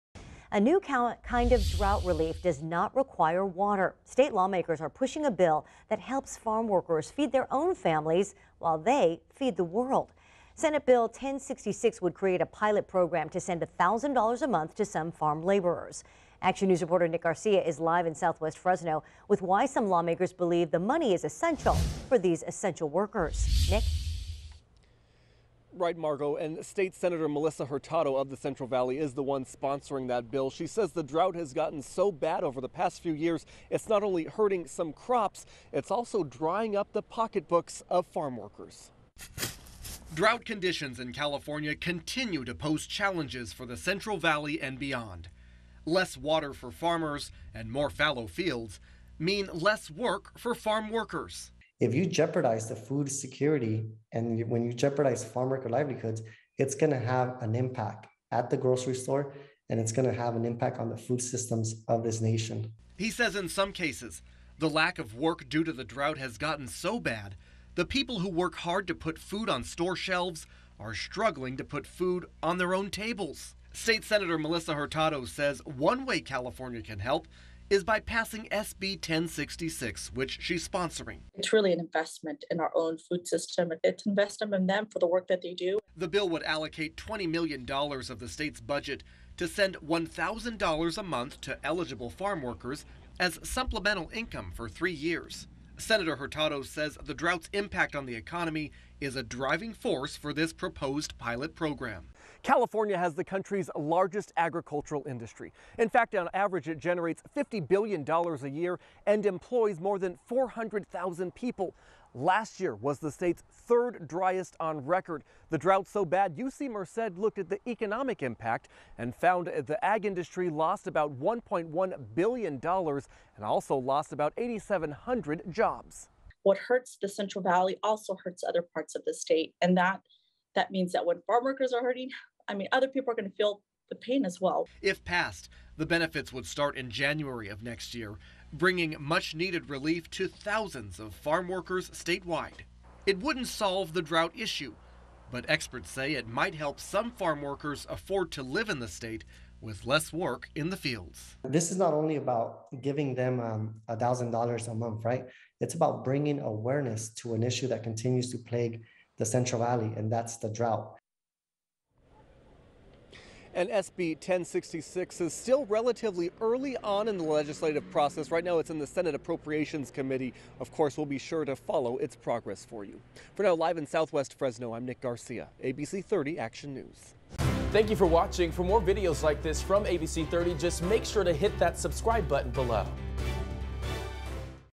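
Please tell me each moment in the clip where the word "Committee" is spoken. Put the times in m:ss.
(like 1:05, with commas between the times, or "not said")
2:49.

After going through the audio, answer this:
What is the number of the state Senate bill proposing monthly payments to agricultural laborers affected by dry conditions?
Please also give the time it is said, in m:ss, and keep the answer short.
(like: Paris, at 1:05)
1066, at 0:10.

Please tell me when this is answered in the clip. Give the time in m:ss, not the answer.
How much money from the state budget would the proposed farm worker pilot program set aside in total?
1:26.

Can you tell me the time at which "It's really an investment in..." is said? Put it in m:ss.
1:21.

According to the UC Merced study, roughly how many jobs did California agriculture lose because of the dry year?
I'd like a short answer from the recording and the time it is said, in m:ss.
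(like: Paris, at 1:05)
8,700, at 2:04.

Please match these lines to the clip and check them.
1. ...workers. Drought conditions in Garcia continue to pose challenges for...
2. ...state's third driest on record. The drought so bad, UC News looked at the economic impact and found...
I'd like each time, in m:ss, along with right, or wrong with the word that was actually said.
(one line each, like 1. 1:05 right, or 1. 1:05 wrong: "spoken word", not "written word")
1. 0:38 wrong: "California", not "Garcia"
2. 1:53 wrong: "Merced", not "News".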